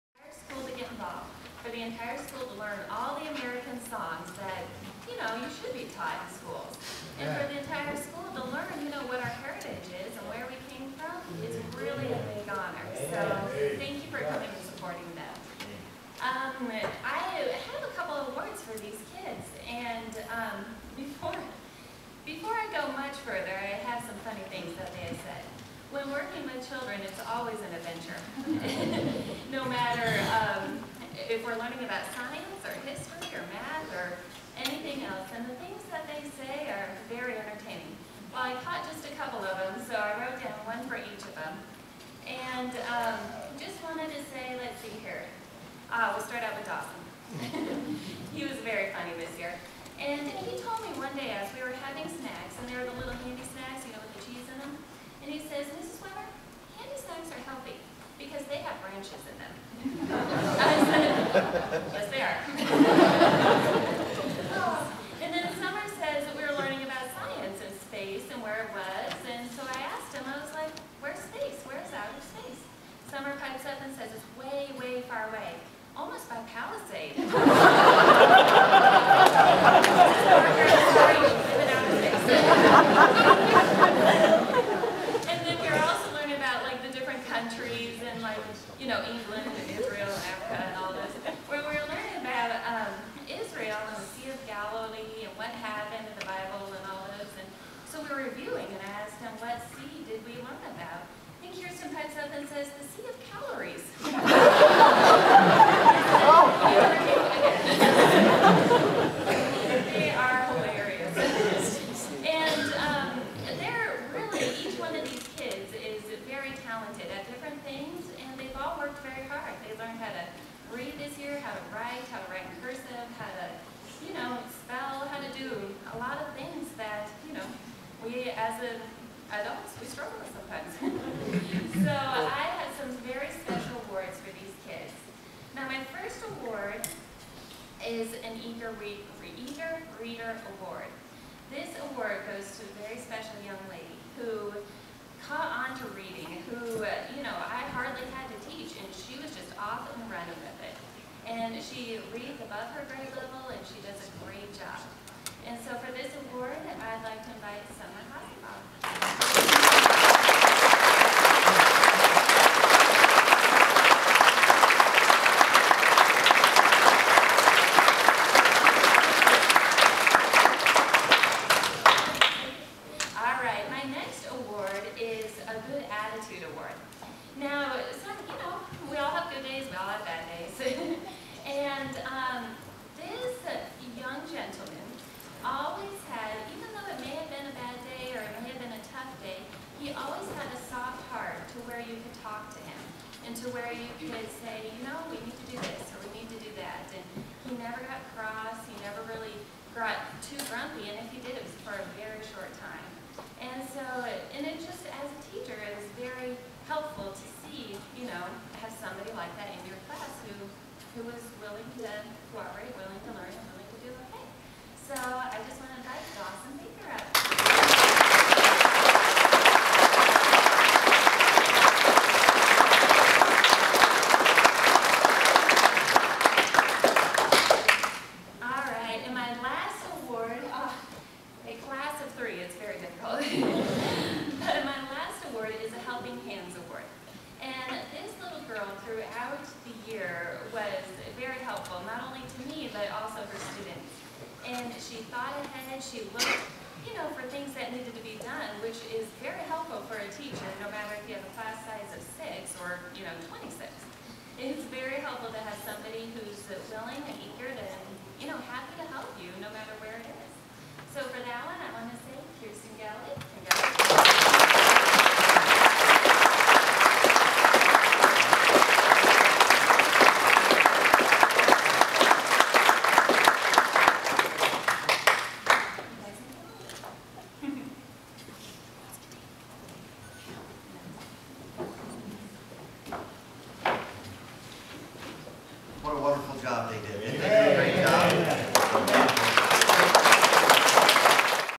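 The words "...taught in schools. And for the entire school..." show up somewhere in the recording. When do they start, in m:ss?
0:05.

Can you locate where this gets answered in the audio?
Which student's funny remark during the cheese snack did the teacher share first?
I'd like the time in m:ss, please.
0:46.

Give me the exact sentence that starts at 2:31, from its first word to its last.
And she reads above her grade level and she does a great job.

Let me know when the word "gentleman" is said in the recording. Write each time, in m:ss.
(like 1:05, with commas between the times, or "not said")
3:04.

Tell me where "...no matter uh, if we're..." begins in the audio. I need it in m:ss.
0:29.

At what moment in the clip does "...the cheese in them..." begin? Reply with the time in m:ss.
0:54.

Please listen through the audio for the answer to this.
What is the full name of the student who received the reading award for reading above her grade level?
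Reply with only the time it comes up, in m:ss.
2:37.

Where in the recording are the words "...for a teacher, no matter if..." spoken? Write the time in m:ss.
4:09.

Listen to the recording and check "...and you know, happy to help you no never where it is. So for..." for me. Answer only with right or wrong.
wrong.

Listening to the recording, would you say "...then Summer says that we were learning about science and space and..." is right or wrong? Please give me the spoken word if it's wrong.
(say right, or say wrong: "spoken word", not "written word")
right.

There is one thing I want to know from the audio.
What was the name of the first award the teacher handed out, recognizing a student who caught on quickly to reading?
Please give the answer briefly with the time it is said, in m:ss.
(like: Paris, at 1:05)
Eager Reader Award, at 2:19.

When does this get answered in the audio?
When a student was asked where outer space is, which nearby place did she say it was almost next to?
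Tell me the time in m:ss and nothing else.
1:16.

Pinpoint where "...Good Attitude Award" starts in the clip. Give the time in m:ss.
2:55.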